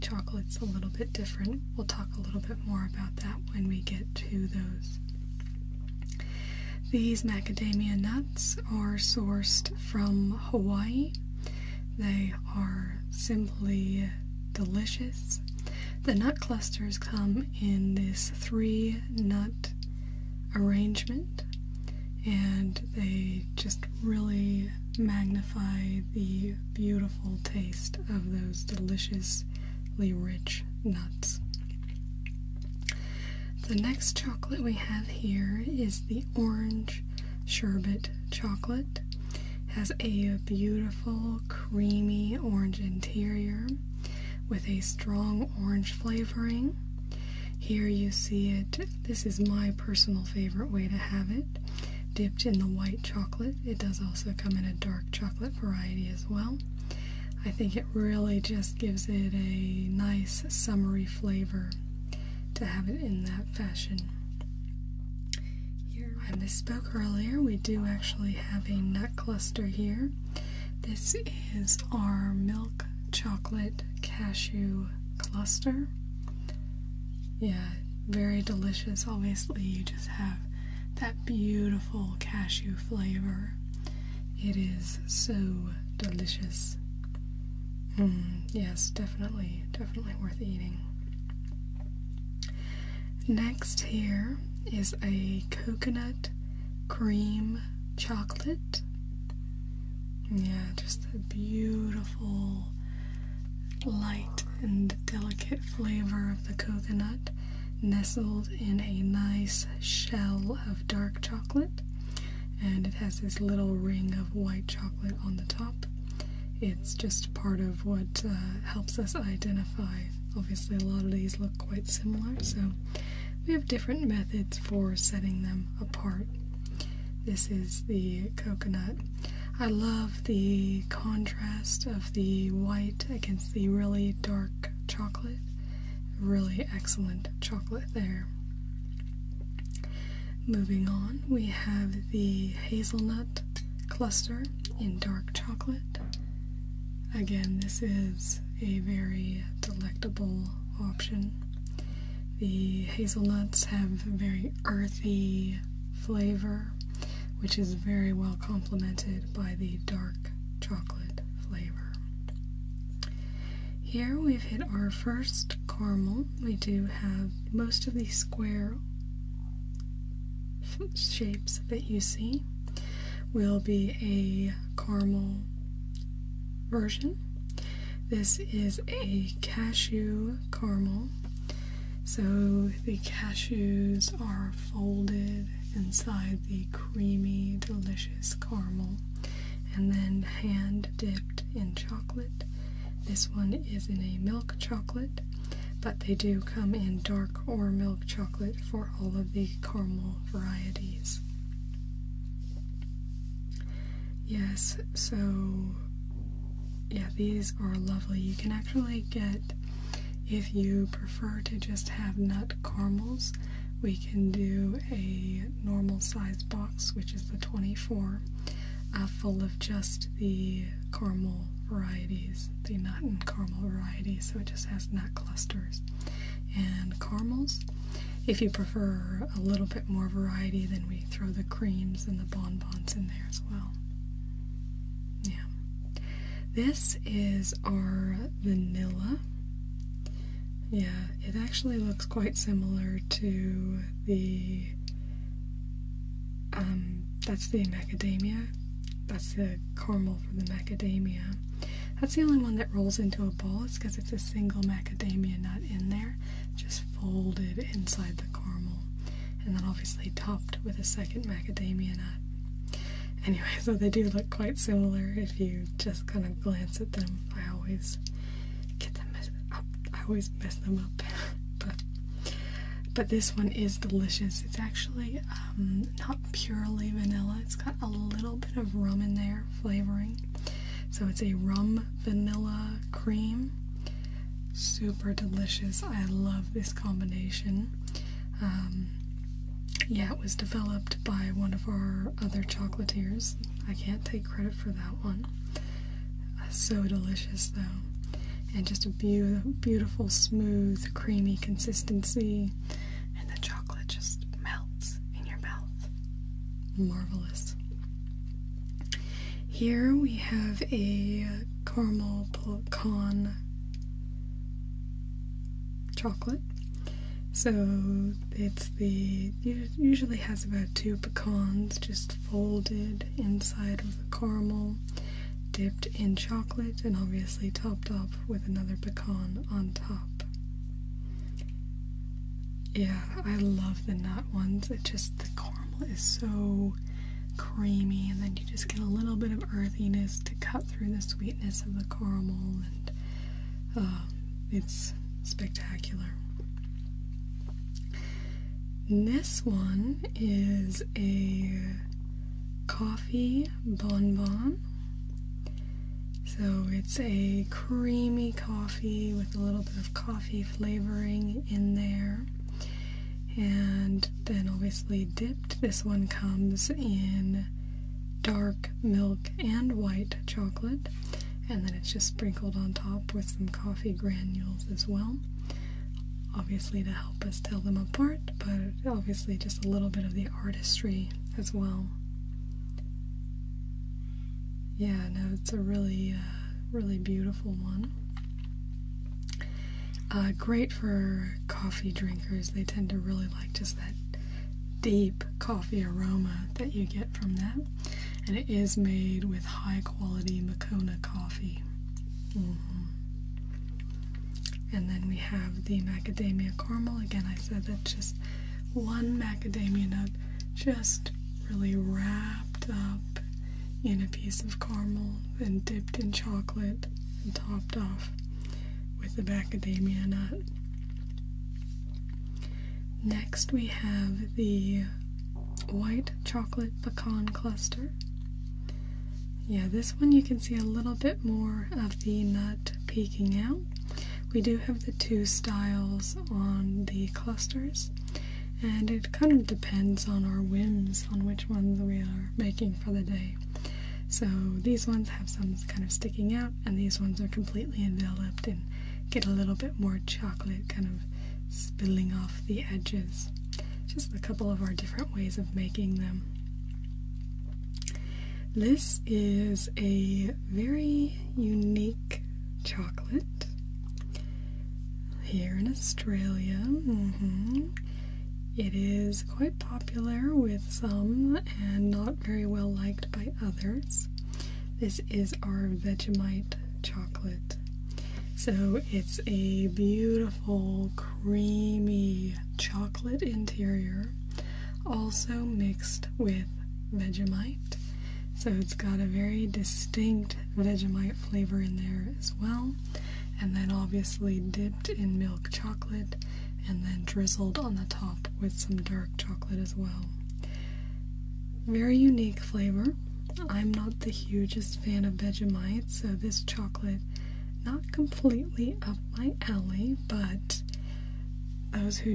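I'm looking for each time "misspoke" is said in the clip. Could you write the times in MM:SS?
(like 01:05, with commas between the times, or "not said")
01:06.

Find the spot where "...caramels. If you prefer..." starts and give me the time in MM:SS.
03:46.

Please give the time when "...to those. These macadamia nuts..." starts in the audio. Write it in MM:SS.
00:04.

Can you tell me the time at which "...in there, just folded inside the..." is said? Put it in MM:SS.
04:15.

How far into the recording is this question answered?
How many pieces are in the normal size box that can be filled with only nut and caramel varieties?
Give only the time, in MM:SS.
03:37.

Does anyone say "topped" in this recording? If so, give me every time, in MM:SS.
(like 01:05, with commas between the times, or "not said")
04:20, 05:27, 06:57.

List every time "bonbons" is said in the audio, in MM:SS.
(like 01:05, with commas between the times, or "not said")
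03:52, 05:53.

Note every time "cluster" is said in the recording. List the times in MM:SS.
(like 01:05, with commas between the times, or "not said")
00:16, 01:09, 01:15, 02:23, 03:45, 07:07, 07:17.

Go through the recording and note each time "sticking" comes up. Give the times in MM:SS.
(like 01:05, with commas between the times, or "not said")
07:25.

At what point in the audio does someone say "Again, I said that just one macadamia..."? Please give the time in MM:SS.
06:47.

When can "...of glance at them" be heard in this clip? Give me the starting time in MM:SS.
04:26.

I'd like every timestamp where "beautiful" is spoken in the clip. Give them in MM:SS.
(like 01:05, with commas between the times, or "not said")
00:26, 00:40, 01:21, 01:41, 04:59, 06:26, 07:59.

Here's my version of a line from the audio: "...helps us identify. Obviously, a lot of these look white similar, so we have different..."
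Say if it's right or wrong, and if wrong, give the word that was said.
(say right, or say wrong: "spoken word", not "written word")
wrong: "quite", not "white".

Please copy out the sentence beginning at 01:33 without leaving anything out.
Next, here is a coconut cream chocolate.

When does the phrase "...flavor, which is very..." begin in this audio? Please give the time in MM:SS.
02:35.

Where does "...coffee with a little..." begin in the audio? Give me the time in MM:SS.
05:58.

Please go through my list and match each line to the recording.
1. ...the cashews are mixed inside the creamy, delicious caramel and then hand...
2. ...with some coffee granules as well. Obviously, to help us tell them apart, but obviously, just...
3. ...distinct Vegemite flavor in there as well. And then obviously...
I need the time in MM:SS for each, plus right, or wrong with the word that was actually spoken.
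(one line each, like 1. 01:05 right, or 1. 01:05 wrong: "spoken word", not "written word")
1. 03:02 wrong: "folded", not "mixed"
2. 06:13 right
3. 08:09 right.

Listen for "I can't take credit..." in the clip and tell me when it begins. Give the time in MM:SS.
04:53.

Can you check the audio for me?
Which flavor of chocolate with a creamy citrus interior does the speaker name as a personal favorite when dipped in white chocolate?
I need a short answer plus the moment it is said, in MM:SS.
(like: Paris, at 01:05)
Orange sherbet, at 00:36.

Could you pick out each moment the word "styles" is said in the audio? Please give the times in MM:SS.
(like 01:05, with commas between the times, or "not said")
07:15.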